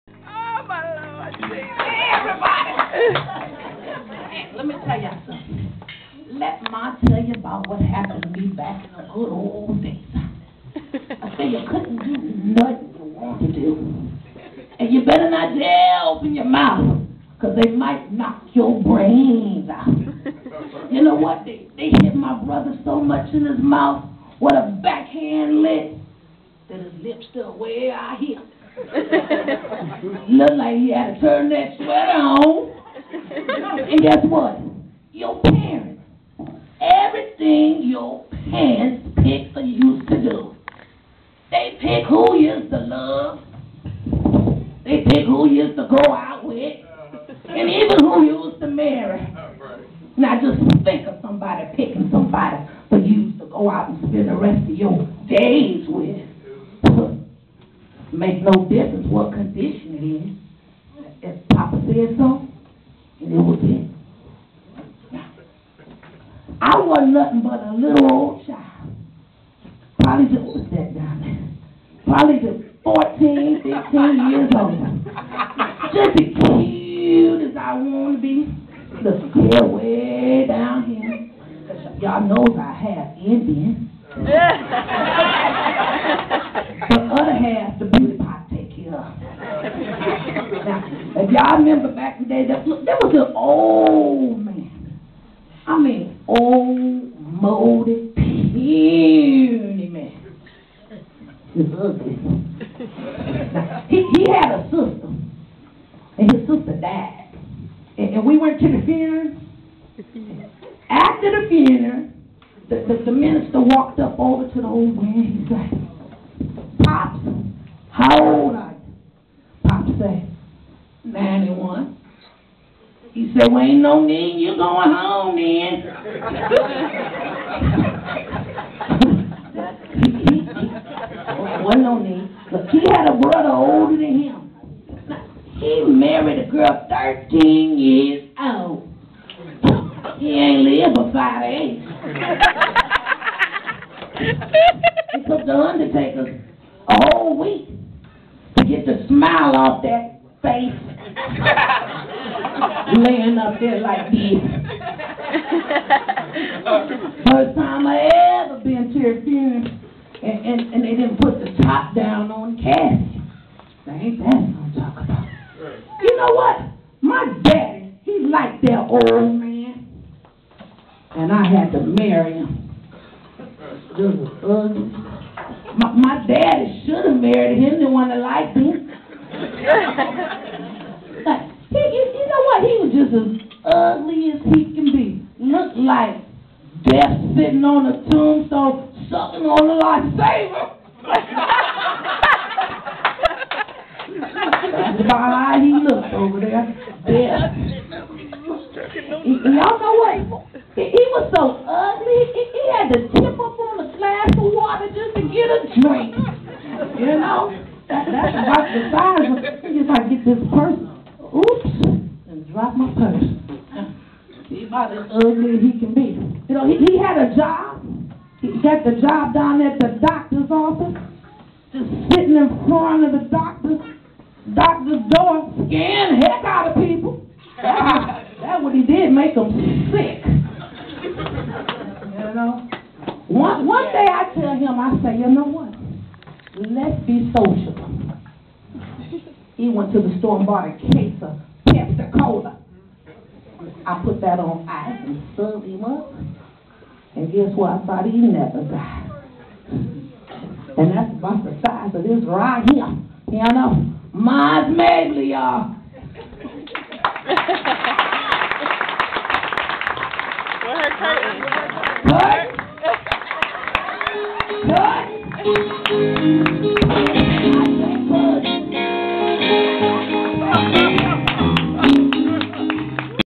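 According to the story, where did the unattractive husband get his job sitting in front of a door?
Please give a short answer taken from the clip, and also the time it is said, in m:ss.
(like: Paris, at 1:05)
The doctor's office, at 3:39.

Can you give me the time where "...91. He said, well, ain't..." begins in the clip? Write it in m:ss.
2:01.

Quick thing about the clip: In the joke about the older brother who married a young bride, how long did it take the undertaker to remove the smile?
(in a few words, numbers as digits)
A whole week.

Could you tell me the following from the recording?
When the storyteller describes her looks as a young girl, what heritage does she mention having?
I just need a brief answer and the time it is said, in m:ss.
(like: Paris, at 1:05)
Indian, at 1:23.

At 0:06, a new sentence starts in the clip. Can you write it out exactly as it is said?
Let Ma tell you about what happened to me back in the good old days.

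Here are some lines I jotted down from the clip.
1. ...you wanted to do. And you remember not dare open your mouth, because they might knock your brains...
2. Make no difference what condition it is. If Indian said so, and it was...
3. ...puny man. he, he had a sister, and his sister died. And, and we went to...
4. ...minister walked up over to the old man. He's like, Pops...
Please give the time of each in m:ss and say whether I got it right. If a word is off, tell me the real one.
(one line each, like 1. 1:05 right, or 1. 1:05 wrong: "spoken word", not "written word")
1. 0:12 wrong: "better", not "remember"
2. 0:58 wrong: "Papa", not "Indian"
3. 1:38 right
4. 1:53 right.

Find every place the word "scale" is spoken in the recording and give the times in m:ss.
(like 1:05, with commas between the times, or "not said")
1:19.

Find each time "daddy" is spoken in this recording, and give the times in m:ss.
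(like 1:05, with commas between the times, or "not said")
2:47, 2:56.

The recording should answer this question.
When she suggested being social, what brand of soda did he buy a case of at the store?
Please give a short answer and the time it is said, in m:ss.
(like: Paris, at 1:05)
Pepsi Cola, at 4:01.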